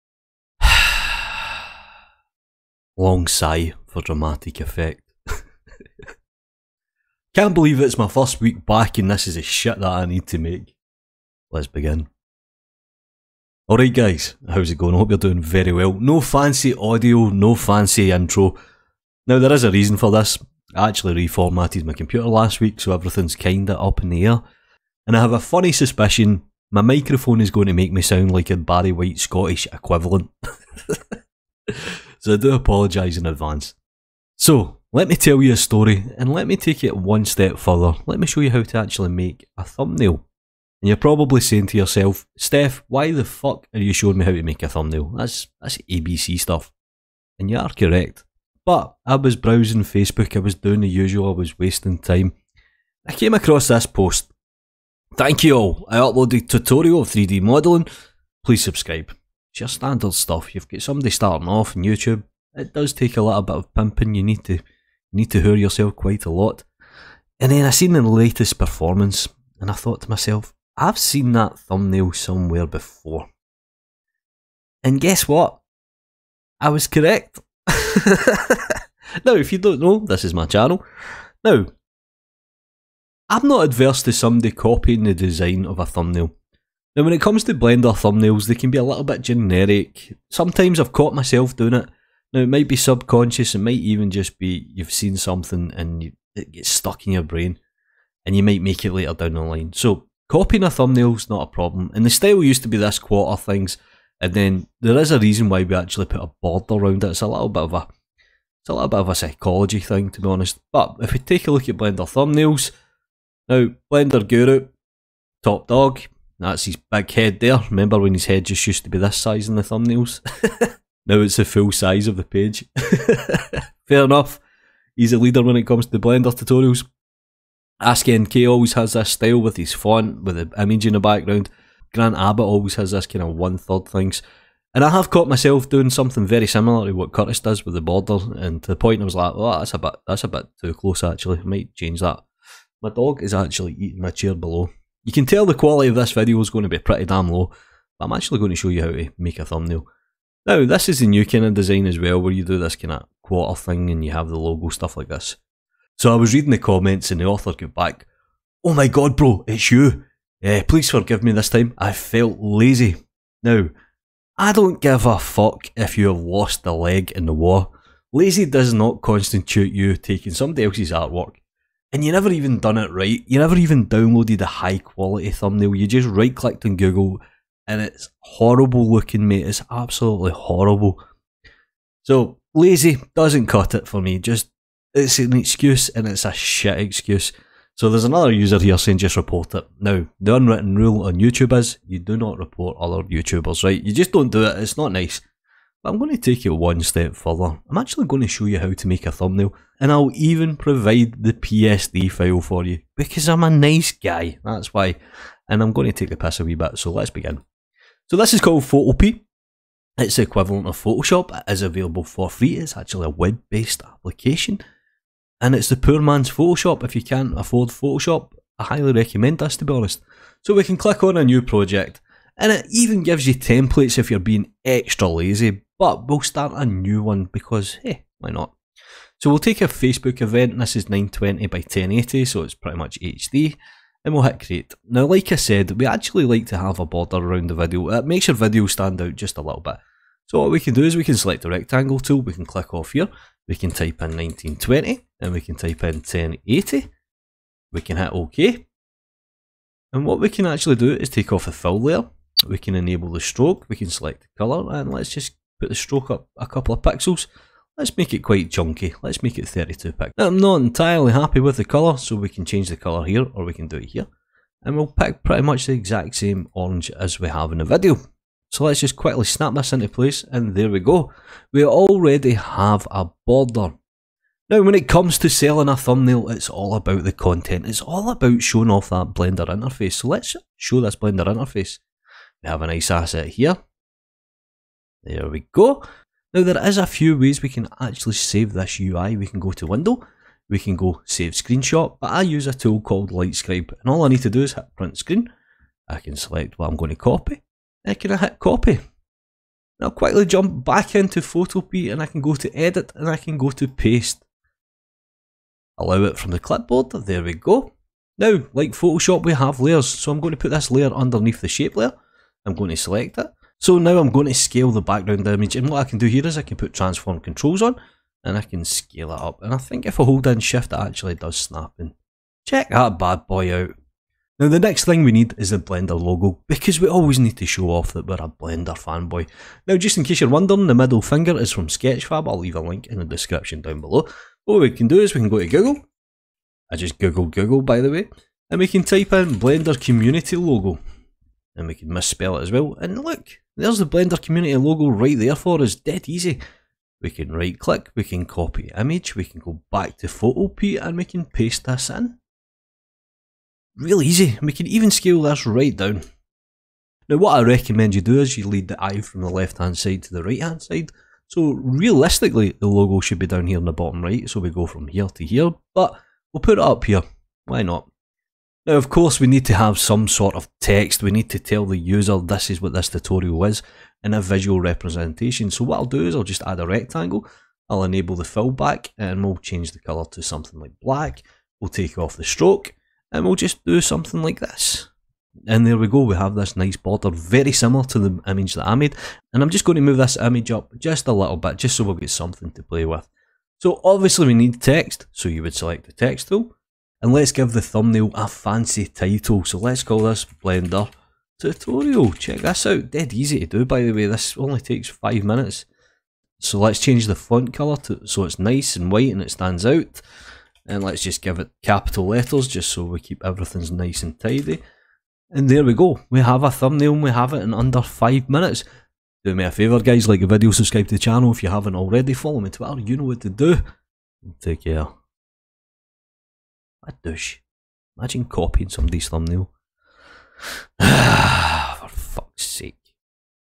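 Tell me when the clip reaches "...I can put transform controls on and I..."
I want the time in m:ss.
5:16.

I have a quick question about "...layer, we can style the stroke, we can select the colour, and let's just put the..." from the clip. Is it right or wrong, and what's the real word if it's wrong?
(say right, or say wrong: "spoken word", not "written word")
wrong: "enable", not "style".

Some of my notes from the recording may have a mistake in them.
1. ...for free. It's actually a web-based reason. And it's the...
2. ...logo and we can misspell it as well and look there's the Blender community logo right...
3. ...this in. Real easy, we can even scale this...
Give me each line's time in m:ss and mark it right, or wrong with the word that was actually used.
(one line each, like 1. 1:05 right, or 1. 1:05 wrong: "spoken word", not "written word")
1. 3:32 wrong: "application", not "reason"
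2. 5:40 right
3. 5:51 right.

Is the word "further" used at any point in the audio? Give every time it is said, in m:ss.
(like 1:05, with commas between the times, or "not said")
0:37, 3:17.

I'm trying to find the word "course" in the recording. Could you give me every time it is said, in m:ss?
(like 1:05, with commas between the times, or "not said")
6:08.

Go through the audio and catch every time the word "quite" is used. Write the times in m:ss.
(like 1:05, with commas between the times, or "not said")
1:05, 4:18.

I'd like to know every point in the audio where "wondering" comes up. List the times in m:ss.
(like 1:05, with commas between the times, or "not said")
5:30.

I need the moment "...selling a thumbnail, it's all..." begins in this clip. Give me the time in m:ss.
4:35.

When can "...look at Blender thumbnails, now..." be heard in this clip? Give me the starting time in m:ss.
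1:51.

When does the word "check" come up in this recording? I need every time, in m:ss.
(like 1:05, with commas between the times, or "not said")
5:22, 6:42.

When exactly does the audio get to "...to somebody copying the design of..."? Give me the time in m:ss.
1:24.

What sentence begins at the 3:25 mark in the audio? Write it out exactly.
And I'm going to take the piss a wee bit, so let's begin.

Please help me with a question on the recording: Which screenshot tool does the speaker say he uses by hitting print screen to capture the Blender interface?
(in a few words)
Lightscribe.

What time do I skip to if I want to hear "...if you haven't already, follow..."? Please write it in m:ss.
7:01.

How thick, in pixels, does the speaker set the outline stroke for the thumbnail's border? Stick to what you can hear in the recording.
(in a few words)
32.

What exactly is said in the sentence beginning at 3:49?
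So we'll take a Facebook event, this is 920 by 1080, so it's pretty much HD, and we'll hit create.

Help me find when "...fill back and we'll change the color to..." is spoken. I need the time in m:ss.
6:18.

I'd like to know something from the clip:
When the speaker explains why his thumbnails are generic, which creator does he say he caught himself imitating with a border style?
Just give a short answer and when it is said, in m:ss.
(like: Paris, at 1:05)
Curtis, at 2:17.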